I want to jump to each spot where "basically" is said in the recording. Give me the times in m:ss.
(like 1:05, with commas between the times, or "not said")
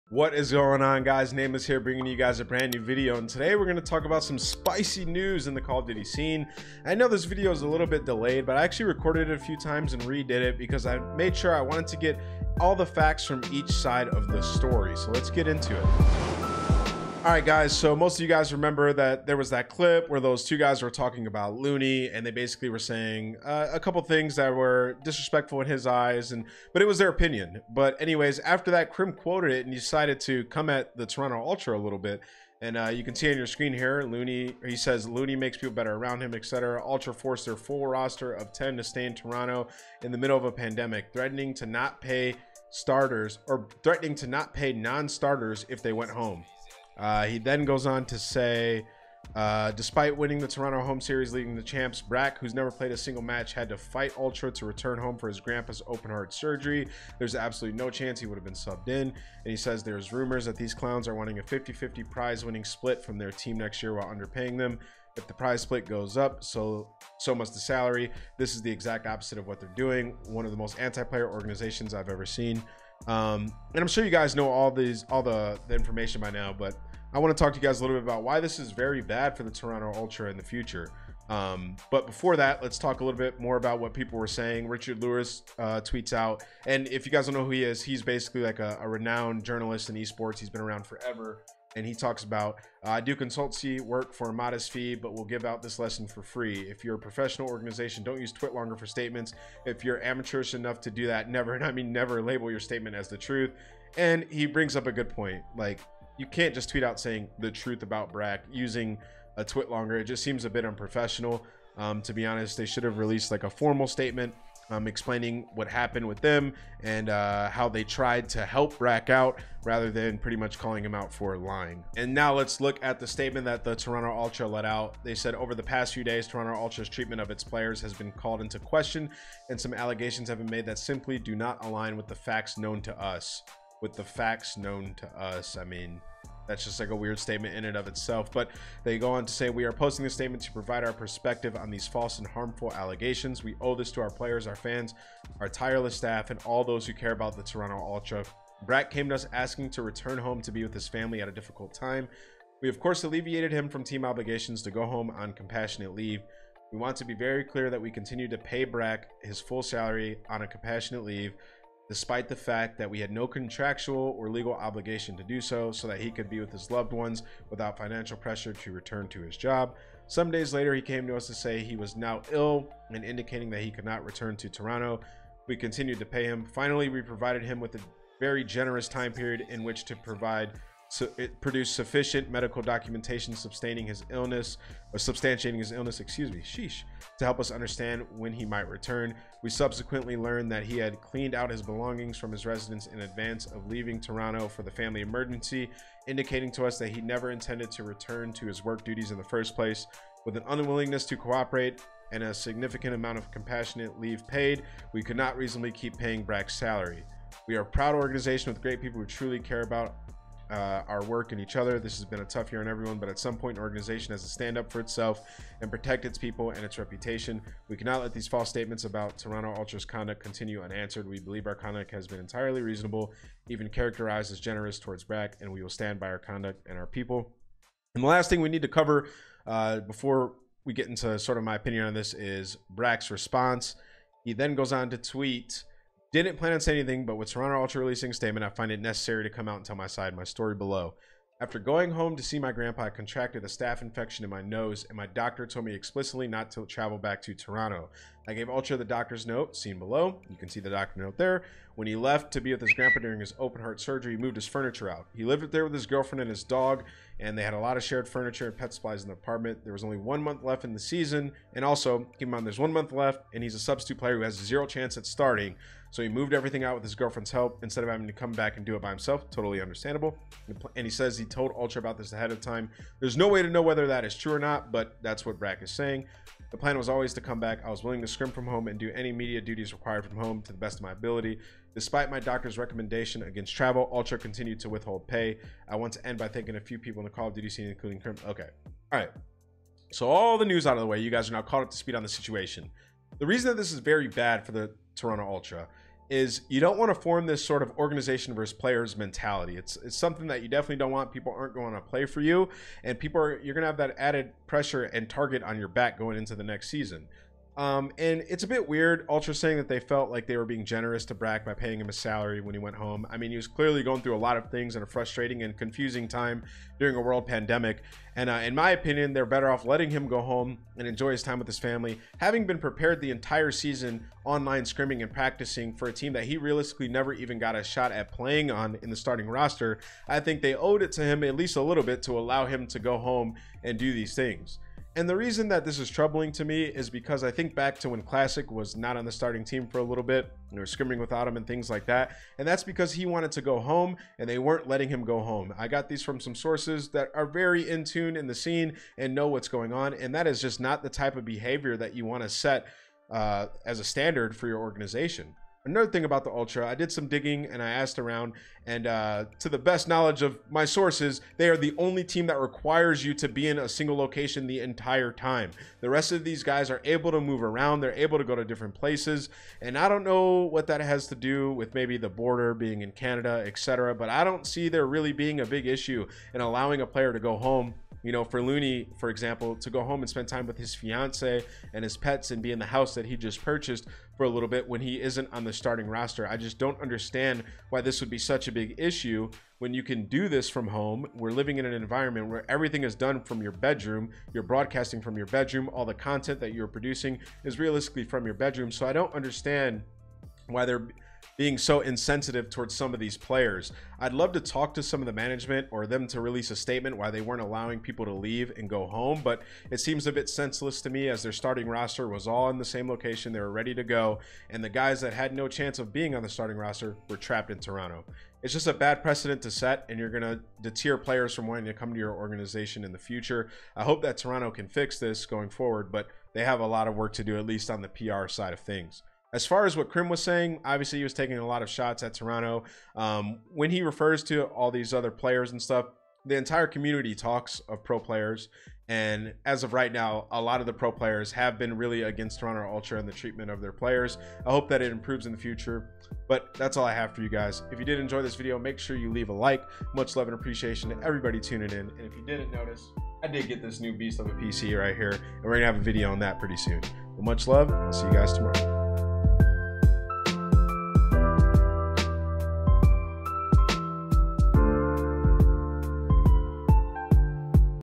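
0:22, 1:28.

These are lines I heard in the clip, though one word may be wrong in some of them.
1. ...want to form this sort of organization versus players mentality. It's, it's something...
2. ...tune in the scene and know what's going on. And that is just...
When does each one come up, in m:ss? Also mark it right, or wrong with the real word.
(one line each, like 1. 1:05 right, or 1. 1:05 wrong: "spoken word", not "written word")
1. 4:56 right
2. 5:47 right.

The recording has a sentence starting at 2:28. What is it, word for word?
Brack came to us asking to return home to be with his family at a difficult time.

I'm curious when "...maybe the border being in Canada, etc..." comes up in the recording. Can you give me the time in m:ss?
6:11.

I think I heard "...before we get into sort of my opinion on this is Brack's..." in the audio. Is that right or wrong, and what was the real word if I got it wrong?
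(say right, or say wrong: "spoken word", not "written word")
right.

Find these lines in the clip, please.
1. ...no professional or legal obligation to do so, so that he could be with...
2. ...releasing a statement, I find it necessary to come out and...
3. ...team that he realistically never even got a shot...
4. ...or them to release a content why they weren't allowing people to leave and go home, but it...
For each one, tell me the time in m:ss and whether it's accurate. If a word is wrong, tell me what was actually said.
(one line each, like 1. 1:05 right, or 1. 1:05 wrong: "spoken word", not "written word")
1. 2:43 wrong: "contractual", not "professional"
2. 3:57 right
3. 5:25 right
4. 6:45 wrong: "statement", not "content".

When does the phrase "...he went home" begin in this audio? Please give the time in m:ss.
5:12.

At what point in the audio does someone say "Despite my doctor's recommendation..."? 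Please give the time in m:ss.
4:41.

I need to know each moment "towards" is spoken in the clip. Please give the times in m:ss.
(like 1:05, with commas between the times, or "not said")
3:44, 6:42.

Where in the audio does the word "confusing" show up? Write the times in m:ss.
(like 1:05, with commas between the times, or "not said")
5:15.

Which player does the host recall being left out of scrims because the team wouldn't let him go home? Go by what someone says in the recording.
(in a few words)
Classic.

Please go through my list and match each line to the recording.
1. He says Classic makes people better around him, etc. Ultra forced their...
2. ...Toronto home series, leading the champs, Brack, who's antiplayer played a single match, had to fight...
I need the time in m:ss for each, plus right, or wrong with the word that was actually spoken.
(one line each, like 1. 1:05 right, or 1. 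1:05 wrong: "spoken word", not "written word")
1. 0:34 wrong: "Looney", not "Classic"
2. 0:50 wrong: "never", not "antiplayer".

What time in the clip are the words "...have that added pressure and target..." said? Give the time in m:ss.
5:03.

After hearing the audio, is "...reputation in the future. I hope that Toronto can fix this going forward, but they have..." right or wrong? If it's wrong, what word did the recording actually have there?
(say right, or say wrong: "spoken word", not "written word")
wrong: "organization", not "reputation".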